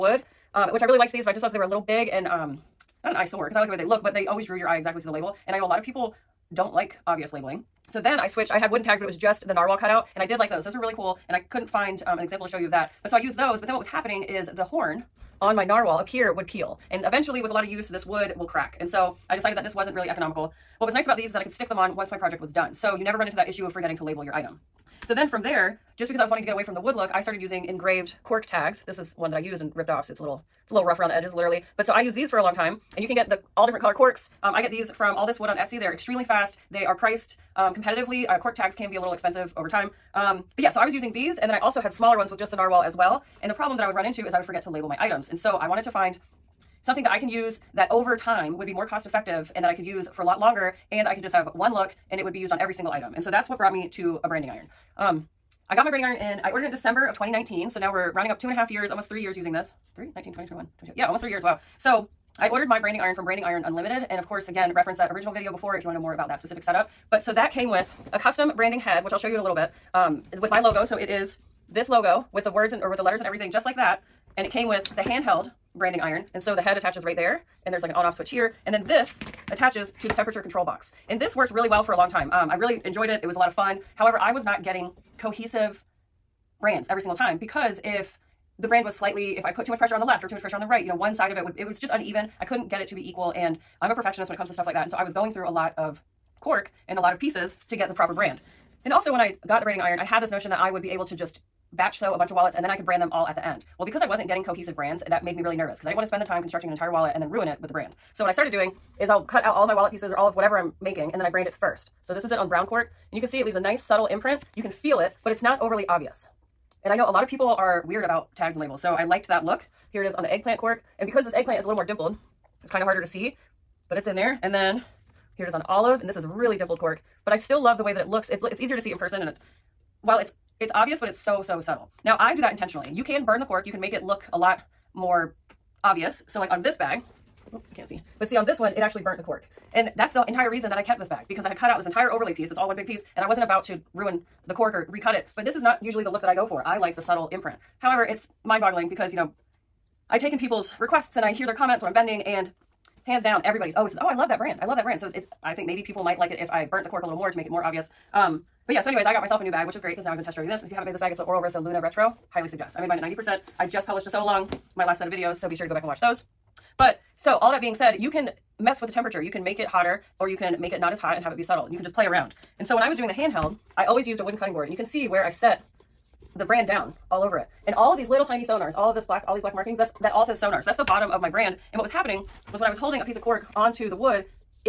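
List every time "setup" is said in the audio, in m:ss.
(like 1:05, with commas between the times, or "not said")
1:06.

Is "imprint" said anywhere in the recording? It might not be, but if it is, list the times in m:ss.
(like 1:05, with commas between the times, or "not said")
1:54, 2:27.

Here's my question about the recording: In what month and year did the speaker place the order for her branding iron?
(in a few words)
December 2019.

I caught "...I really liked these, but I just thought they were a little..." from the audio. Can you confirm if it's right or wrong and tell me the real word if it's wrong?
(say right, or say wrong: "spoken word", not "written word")
right.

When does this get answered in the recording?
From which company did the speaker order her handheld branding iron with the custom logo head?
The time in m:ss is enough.
1:03.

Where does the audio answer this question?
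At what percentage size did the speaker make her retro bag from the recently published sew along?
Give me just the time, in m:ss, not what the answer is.
2:43.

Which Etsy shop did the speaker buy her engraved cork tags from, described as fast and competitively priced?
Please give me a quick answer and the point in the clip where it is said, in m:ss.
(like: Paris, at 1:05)
All This Wood, at 0:35.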